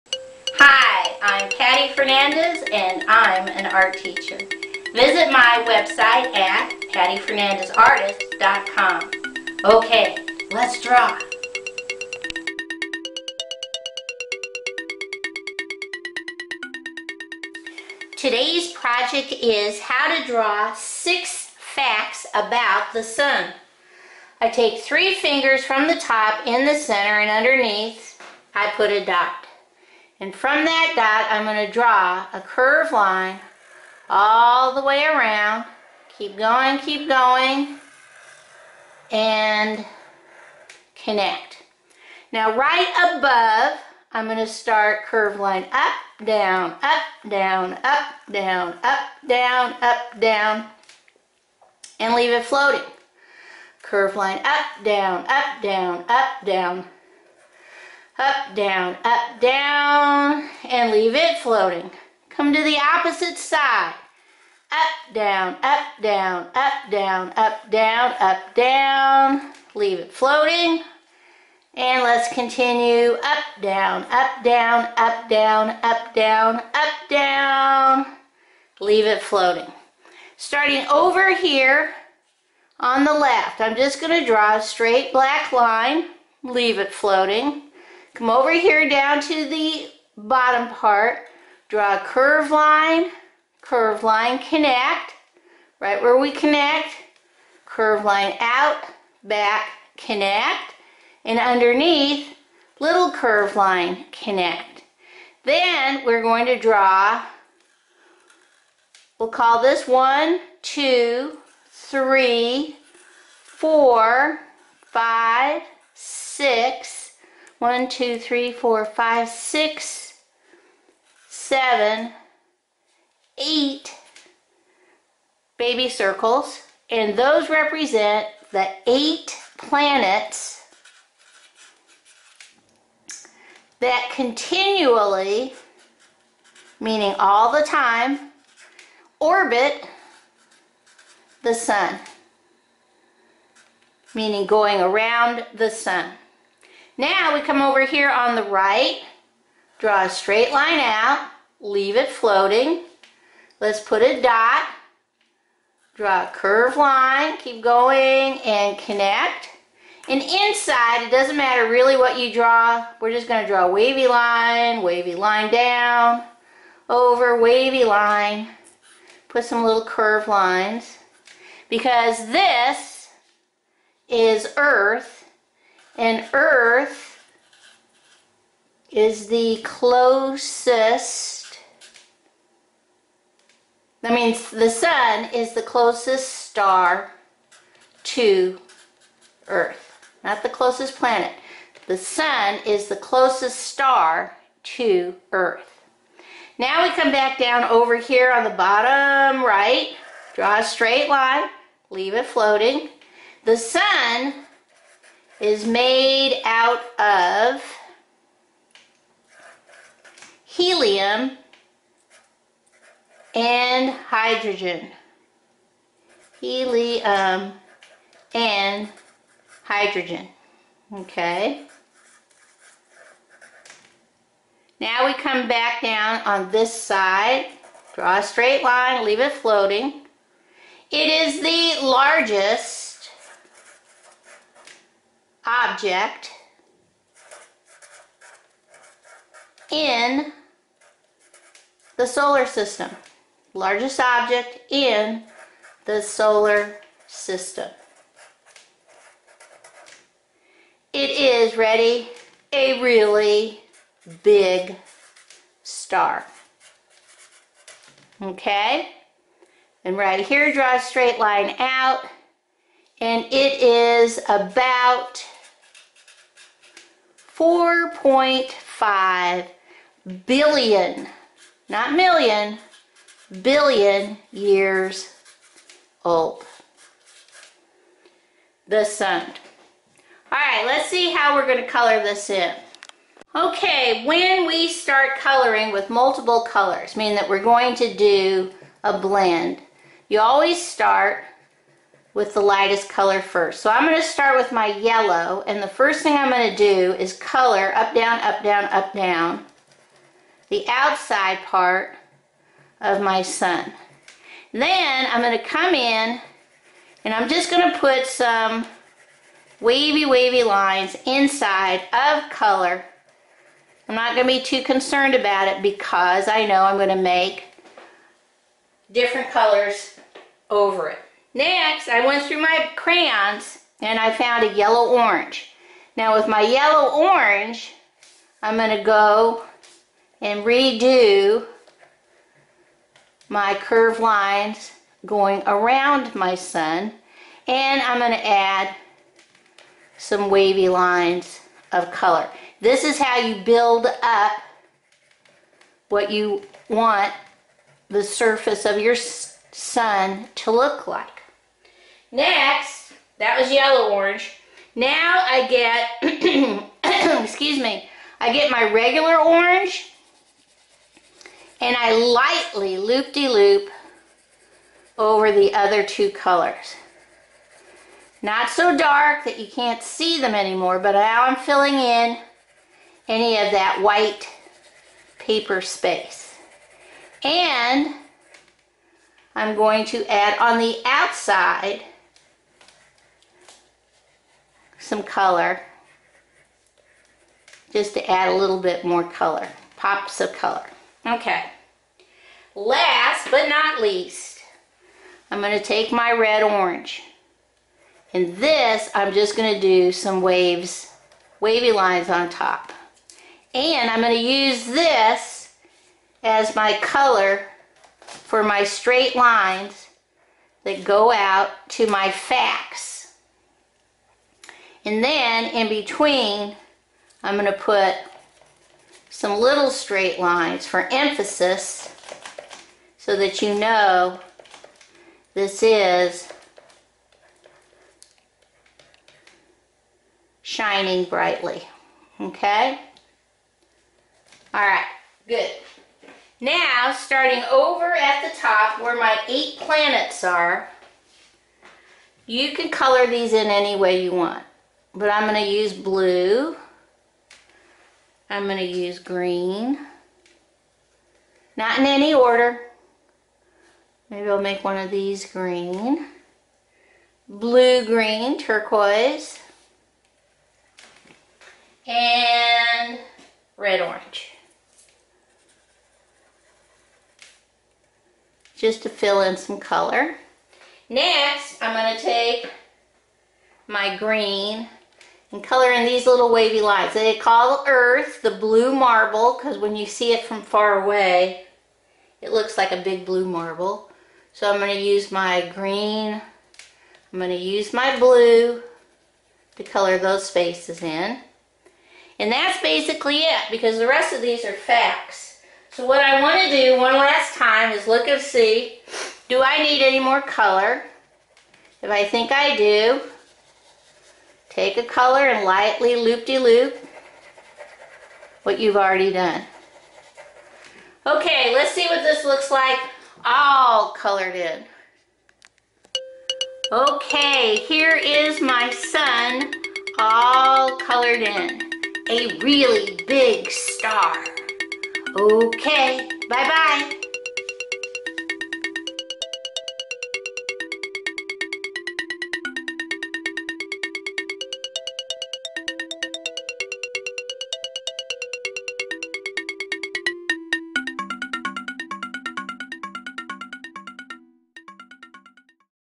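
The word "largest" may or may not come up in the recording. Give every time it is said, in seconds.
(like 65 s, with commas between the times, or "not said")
231 s, 243 s.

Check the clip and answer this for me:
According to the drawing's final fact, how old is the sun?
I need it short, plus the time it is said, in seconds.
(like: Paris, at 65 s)
4.5 billion years, at 267 s.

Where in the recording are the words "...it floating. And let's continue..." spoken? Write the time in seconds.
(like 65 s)
69 s.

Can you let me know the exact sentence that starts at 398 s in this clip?
And this, I'm just going to do some waves, wavy lines on top.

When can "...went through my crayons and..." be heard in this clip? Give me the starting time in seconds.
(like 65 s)
322 s.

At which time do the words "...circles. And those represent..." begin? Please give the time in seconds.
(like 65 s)
125 s.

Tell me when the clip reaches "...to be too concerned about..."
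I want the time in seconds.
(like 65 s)
314 s.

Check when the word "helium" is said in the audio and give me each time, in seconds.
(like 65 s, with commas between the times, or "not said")
210 s, 216 s.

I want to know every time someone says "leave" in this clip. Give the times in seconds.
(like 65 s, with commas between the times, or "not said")
52 s, 60 s, 69 s, 78 s, 86 s, 151 s, 201 s, 229 s.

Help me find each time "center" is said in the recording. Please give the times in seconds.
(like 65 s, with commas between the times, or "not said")
26 s.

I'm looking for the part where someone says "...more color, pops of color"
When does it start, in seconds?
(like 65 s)
388 s.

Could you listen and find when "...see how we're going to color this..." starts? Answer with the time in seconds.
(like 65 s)
280 s.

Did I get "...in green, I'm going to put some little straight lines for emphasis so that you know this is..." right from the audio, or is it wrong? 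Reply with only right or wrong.
wrong.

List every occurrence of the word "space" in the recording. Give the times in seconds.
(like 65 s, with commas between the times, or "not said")
375 s, 490 s.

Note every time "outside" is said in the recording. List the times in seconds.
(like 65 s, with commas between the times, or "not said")
300 s, 380 s.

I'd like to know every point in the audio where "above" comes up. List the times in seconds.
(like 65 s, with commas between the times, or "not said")
43 s.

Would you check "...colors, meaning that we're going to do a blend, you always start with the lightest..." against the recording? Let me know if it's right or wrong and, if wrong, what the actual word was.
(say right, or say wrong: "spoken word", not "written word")
right.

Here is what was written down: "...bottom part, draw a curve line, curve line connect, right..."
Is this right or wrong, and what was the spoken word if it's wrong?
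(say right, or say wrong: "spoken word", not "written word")
right.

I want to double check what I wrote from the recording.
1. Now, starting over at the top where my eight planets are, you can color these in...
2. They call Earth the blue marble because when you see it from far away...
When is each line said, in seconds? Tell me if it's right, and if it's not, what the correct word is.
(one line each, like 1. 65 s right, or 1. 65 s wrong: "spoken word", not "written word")
1. 436 s right
2. 476 s right.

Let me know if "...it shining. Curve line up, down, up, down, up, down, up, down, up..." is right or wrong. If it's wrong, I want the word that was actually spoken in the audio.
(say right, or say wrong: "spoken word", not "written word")
wrong: "floating", not "shining".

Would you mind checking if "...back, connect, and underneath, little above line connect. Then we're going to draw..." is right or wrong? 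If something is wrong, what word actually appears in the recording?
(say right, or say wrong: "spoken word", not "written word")
wrong: "curve", not "above".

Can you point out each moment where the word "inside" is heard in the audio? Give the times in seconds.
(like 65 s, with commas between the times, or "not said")
160 s, 311 s.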